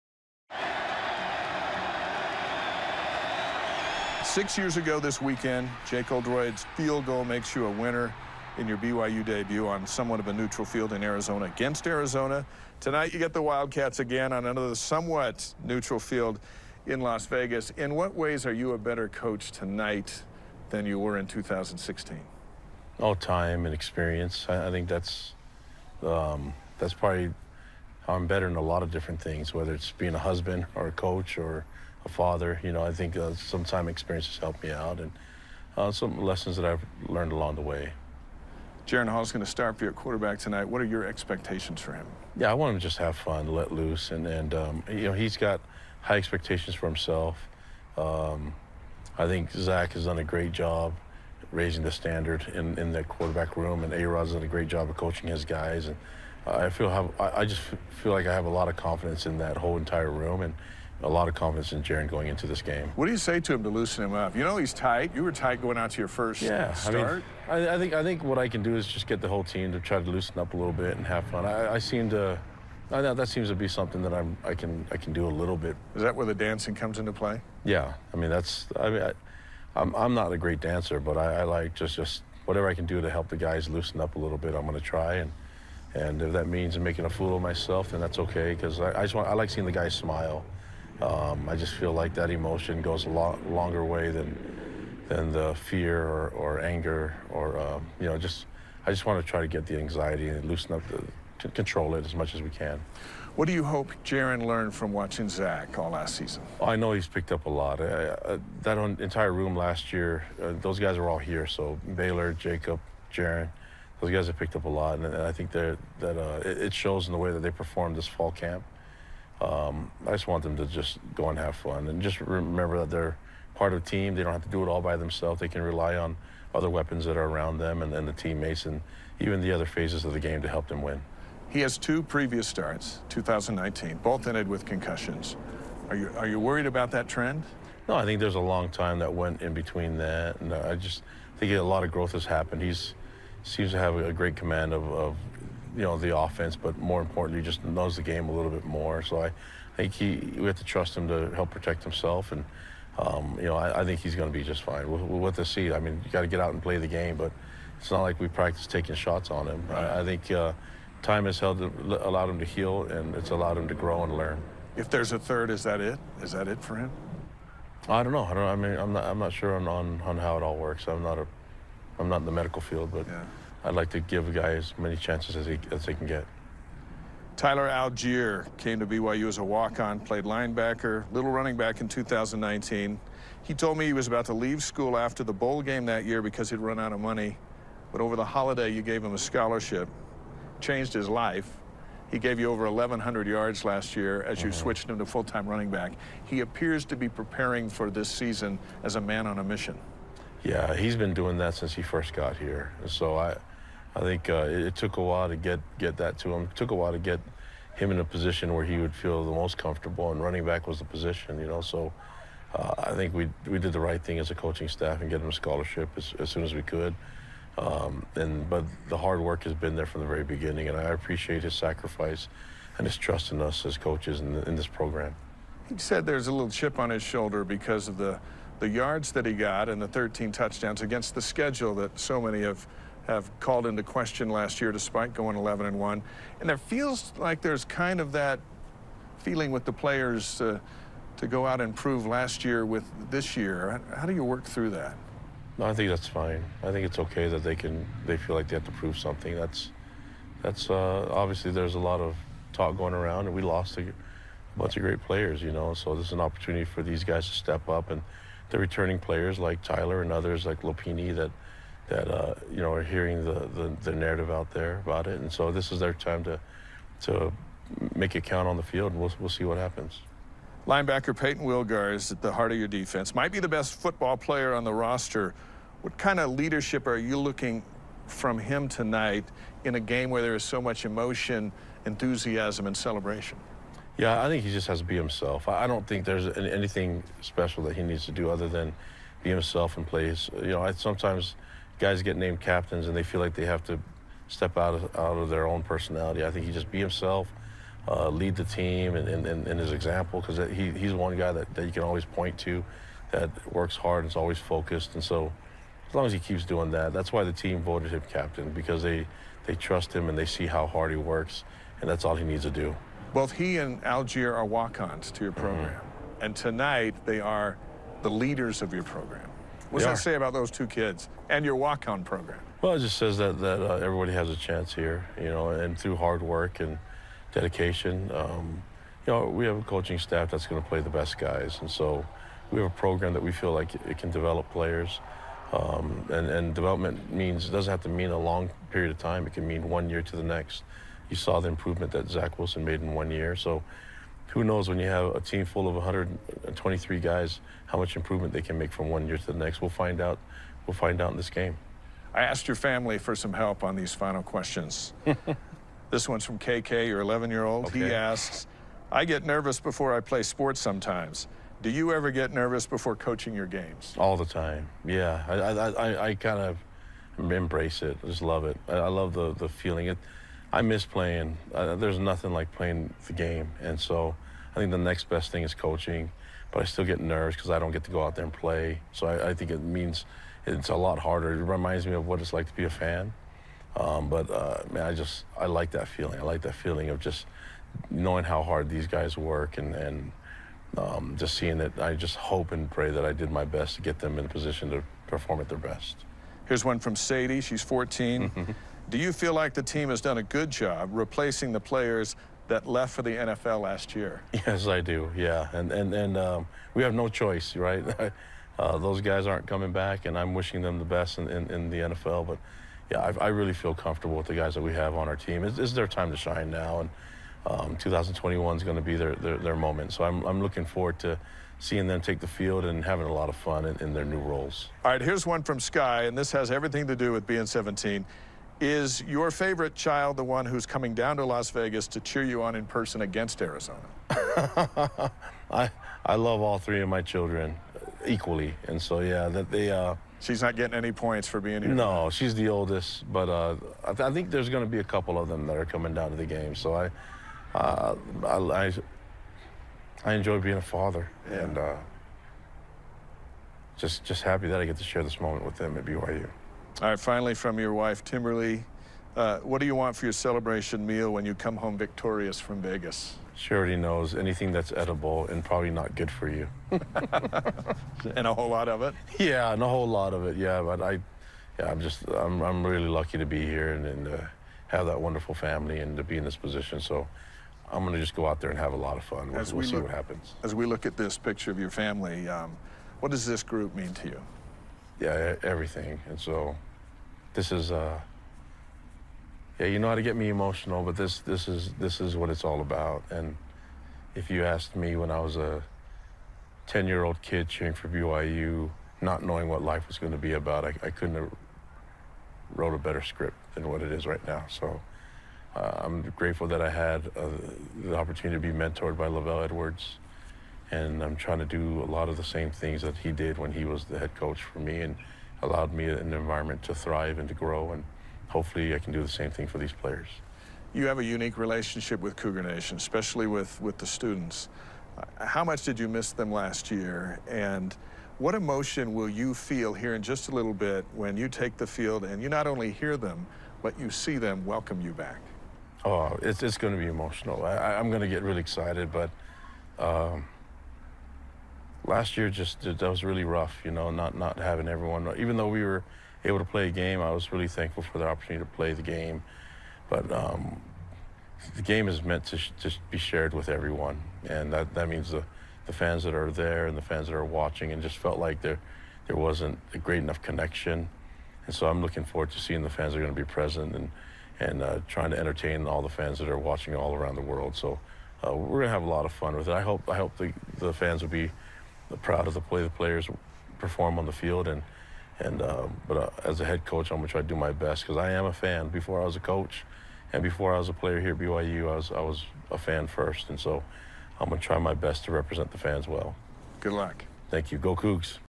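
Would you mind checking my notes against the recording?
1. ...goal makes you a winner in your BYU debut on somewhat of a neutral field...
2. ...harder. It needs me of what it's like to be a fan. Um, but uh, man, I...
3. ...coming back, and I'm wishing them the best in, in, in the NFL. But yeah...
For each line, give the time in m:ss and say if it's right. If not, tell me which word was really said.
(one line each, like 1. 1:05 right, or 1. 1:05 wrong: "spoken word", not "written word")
1. 0:07 right
2. 6:20 wrong: "reminds", not "needs"
3. 6:49 right.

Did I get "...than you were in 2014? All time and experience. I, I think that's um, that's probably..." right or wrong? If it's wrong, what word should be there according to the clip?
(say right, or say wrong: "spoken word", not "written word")
wrong: "2016", not "2014".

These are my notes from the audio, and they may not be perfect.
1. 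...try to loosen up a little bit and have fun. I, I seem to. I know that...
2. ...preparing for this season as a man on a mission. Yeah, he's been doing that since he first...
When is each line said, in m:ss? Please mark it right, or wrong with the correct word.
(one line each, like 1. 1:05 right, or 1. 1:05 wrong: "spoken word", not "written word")
1. 1:09 right
2. 3:17 right.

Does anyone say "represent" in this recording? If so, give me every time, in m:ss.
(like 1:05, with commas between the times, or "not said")
9:45.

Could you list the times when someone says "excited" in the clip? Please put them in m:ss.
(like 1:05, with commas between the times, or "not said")
8:58.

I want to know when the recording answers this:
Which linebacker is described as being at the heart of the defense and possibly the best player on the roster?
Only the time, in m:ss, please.
4:31.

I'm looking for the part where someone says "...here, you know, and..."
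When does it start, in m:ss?
5:24.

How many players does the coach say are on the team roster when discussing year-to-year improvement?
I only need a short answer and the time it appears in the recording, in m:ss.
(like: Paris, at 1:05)
123, at 5:45.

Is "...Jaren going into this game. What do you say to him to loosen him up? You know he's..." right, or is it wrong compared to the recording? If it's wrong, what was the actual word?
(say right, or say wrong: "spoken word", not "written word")
right.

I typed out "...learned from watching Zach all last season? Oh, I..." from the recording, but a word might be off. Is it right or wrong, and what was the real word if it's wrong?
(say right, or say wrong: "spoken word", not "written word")
right.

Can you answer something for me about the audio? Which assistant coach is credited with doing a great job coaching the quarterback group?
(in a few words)
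A-Rod.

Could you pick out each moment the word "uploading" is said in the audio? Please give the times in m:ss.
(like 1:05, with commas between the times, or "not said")
not said.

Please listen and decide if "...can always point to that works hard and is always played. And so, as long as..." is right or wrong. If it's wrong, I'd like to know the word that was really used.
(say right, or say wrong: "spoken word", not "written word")
wrong: "focused", not "played".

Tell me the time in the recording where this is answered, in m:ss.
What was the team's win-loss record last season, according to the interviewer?
3:55.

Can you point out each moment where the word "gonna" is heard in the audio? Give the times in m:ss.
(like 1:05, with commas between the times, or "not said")
9:36, 9:44.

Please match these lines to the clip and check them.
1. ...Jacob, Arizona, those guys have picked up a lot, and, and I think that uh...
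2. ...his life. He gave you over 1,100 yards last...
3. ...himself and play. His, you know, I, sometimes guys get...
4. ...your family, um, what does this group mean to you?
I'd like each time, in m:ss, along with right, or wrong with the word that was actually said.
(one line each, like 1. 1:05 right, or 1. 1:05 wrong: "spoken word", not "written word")
1. 1:52 wrong: "Jaren", not "Arizona"
2. 3:10 right
3. 4:49 right
4. 8:01 right.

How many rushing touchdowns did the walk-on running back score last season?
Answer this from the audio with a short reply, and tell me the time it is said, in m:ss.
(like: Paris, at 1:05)
13, at 3:49.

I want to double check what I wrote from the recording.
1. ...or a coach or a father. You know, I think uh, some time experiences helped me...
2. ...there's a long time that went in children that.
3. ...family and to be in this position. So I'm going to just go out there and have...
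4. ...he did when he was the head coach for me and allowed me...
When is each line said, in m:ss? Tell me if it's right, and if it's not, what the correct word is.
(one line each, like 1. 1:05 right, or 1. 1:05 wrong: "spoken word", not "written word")
1. 0:30 right
2. 2:18 wrong: "between", not "children"
3. 7:55 right
4. 8:32 right.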